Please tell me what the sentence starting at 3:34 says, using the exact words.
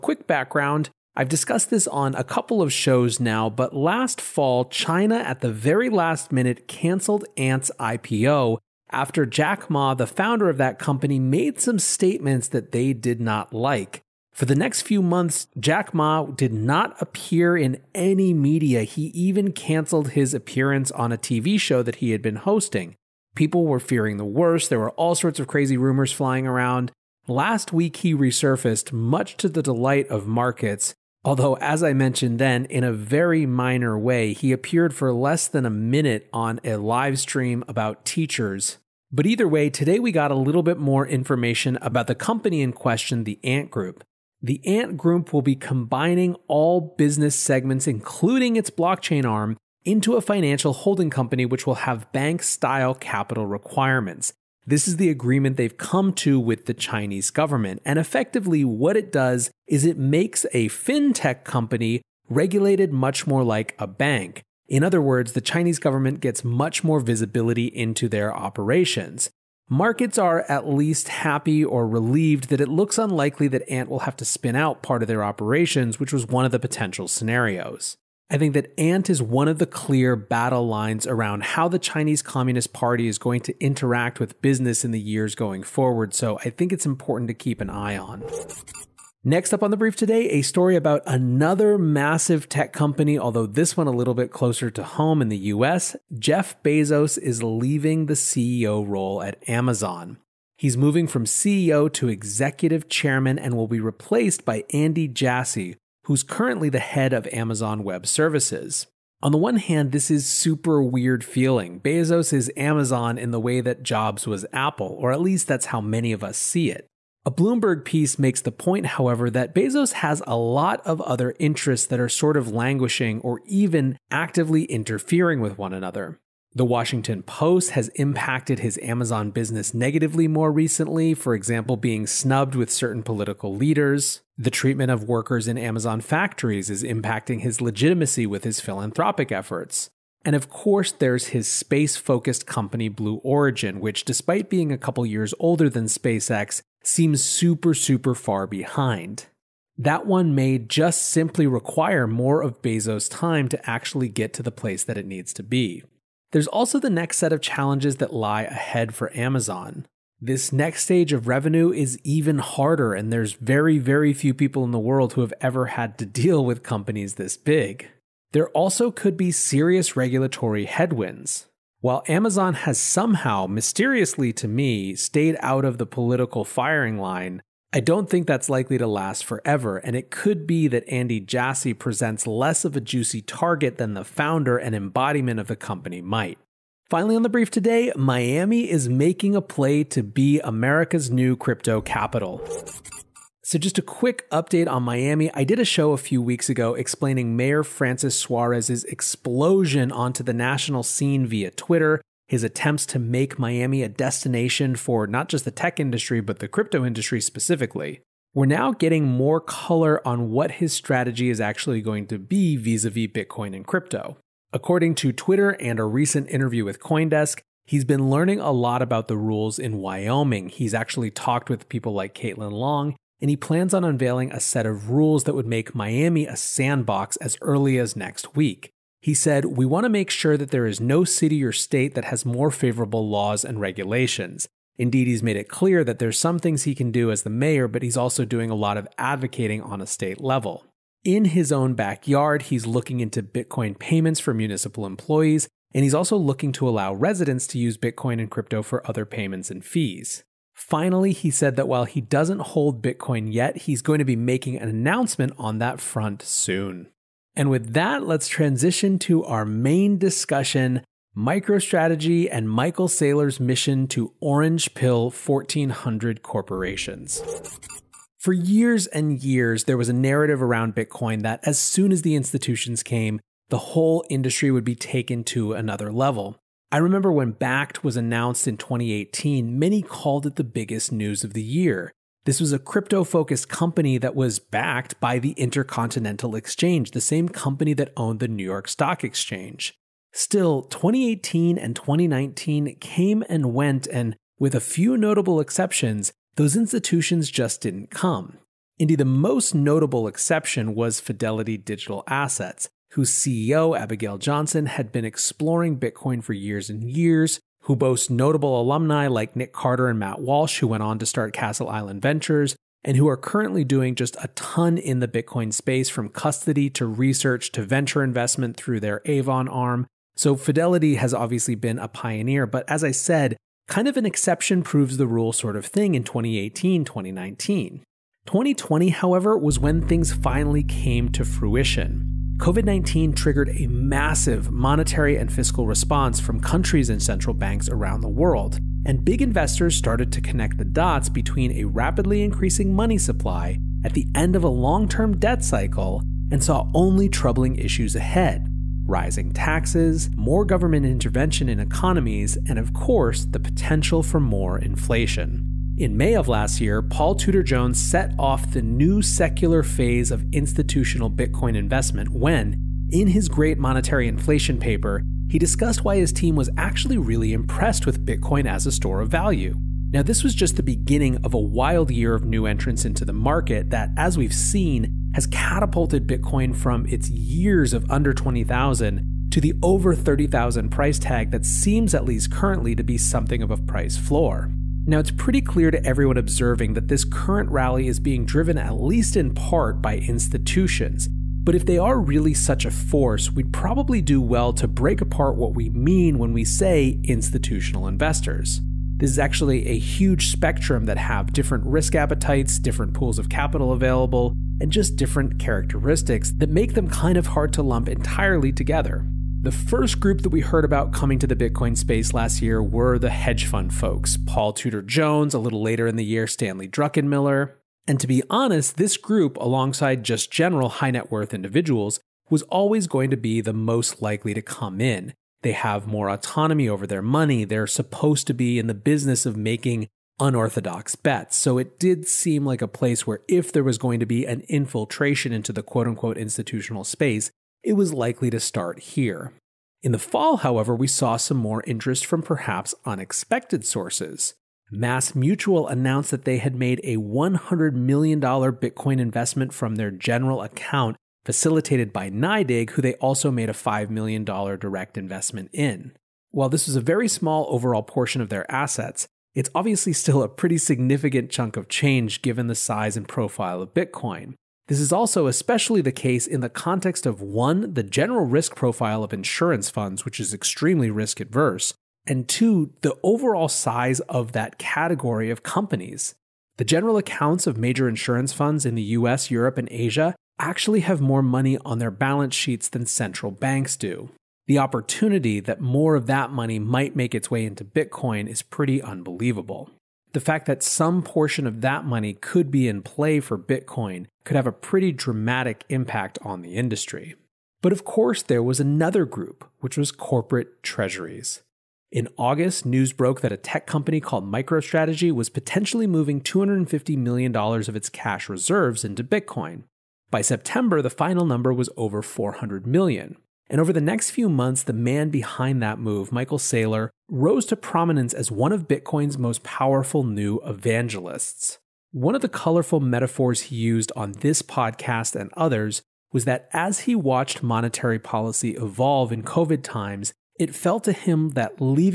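According to Twitter and a recent interview with Coindesk, he's been learning a lot about the rules in Wyoming.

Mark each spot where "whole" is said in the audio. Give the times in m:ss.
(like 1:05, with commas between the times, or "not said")
4:33.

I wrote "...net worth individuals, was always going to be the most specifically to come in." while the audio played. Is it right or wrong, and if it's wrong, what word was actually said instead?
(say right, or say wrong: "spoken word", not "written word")
wrong: "likely", not "specifically".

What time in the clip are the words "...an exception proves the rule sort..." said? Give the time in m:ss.
5:23.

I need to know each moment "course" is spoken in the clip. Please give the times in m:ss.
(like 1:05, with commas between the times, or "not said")
2:20, 5:52, 8:17.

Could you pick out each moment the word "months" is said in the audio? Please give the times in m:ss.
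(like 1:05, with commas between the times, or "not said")
0:15, 8:34.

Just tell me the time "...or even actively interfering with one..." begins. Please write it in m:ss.
2:03.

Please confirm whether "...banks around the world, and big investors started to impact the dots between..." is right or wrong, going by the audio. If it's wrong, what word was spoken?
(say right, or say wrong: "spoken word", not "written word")
wrong: "connect", not "impact".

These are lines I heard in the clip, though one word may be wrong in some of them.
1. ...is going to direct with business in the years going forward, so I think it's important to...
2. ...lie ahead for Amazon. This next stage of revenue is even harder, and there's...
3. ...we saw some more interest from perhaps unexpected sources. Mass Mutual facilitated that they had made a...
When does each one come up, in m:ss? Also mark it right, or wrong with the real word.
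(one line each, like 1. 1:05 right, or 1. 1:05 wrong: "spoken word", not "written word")
1. 1:23 wrong: "interact", not "direct"
2. 2:38 right
3. 7:20 wrong: "announced", not "facilitated".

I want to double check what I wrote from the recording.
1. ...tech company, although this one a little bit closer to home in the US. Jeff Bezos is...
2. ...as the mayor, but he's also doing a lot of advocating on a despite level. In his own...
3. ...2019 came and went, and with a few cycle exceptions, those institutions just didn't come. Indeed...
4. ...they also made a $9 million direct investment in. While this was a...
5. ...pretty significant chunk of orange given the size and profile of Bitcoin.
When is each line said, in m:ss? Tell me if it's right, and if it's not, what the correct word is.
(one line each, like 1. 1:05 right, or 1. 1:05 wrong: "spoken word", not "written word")
1. 1:32 right
2. 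3:57 wrong: "state", not "despite"
3. 4:51 wrong: "notable", not "cycle"
4. 7:32 wrong: "5", not "9"
5. 7:40 wrong: "change", not "orange".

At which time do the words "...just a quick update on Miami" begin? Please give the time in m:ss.
3:13.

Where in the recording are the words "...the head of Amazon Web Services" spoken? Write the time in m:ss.
1:46.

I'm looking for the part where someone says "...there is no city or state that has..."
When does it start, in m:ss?
3:50.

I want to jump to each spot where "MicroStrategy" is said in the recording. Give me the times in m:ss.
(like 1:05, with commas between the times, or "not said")
4:21, 8:24.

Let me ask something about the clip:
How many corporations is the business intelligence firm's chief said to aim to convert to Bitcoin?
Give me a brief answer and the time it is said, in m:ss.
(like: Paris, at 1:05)
1,400, at 4:25.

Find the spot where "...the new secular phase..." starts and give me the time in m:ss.
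5:58.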